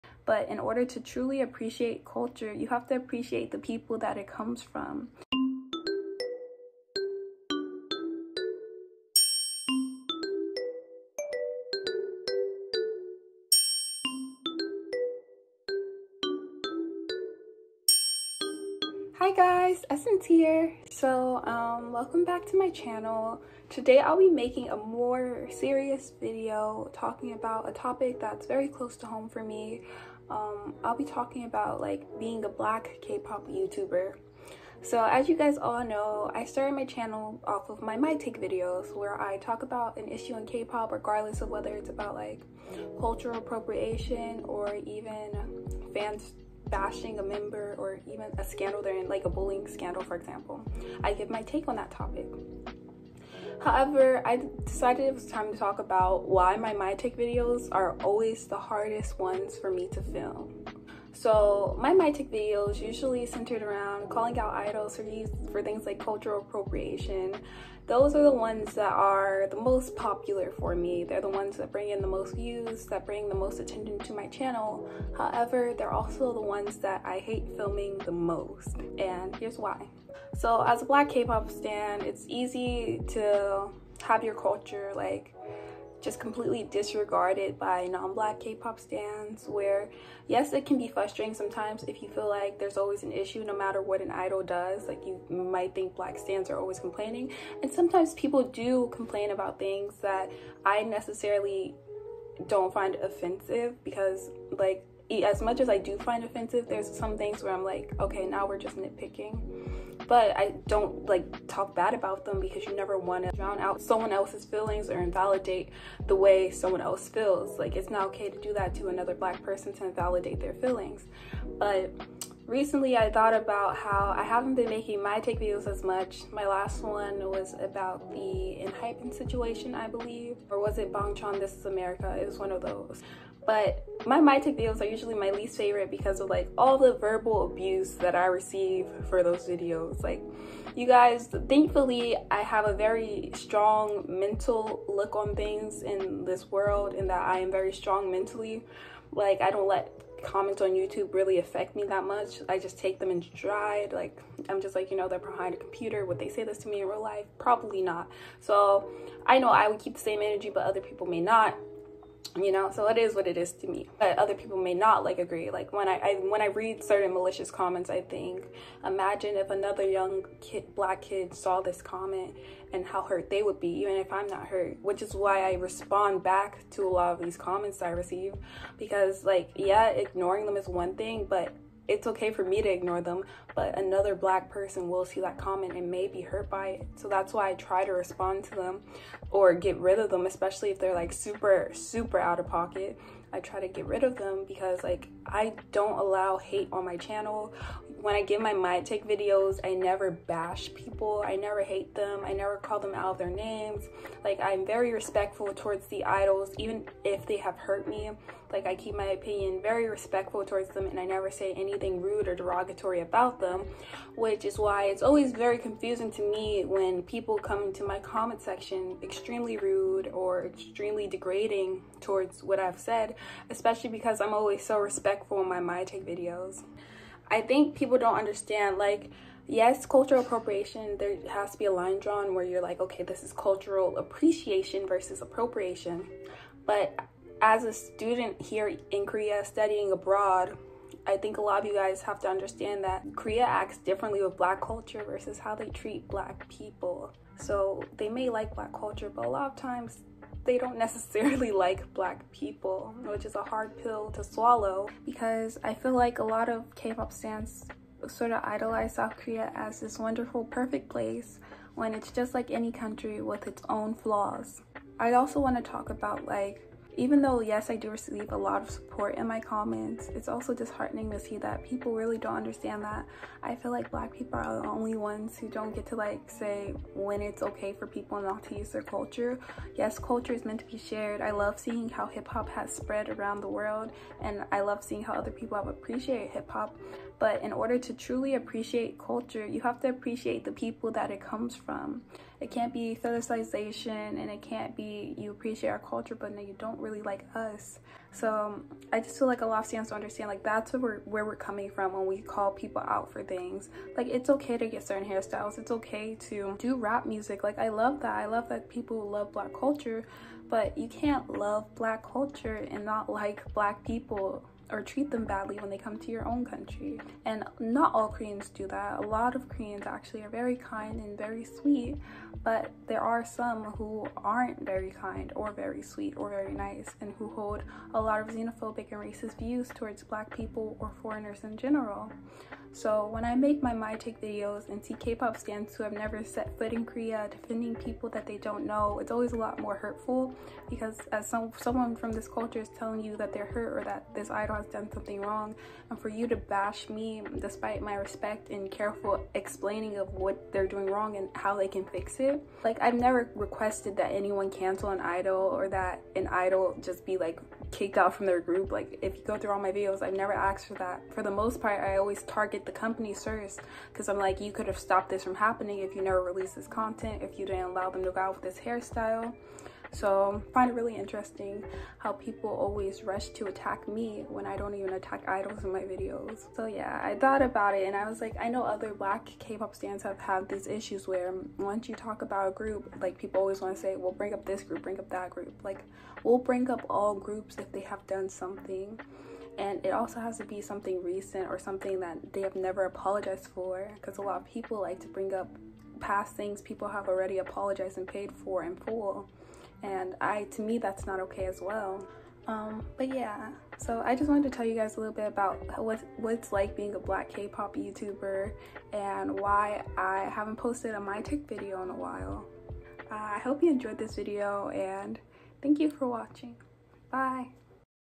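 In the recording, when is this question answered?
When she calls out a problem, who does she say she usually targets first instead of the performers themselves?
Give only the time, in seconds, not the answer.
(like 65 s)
362 s.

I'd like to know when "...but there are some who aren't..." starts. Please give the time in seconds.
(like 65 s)
322 s.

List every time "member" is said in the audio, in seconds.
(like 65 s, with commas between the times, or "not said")
47 s.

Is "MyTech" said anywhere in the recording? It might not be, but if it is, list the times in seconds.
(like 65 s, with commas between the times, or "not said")
56 s, 61 s.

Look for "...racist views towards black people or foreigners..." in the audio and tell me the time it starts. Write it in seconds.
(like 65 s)
329 s.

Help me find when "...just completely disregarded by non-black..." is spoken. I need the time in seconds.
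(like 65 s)
86 s.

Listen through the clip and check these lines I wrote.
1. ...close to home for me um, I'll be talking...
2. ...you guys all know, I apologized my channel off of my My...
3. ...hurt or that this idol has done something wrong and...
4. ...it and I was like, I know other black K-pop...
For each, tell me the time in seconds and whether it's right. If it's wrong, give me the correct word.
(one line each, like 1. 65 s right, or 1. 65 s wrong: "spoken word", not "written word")
1. 28 s right
2. 35 s wrong: "started", not "apologized"
3. 343 s right
4. 377 s right.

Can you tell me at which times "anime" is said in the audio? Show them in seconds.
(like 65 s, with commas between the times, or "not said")
not said.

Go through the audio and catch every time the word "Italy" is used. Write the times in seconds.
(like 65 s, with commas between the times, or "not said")
not said.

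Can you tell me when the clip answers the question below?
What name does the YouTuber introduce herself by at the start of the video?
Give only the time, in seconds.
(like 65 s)
19 s.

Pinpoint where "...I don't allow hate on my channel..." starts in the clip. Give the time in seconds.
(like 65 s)
195 s.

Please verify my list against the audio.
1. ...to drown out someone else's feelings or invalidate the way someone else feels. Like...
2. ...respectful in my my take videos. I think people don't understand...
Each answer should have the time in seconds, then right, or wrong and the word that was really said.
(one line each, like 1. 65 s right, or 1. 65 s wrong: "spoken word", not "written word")
1. 113 s right
2. 224 s right.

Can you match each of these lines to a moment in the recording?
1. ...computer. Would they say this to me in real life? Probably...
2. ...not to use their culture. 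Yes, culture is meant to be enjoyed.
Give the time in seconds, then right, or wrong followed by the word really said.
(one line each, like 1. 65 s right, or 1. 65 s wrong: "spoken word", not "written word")
1. 155 s right
2. 278 s wrong: "shared", not "enjoyed".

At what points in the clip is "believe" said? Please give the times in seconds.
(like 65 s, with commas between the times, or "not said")
129 s.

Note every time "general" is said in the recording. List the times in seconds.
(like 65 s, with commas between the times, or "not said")
331 s.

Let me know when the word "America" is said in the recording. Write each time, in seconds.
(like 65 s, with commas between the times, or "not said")
131 s.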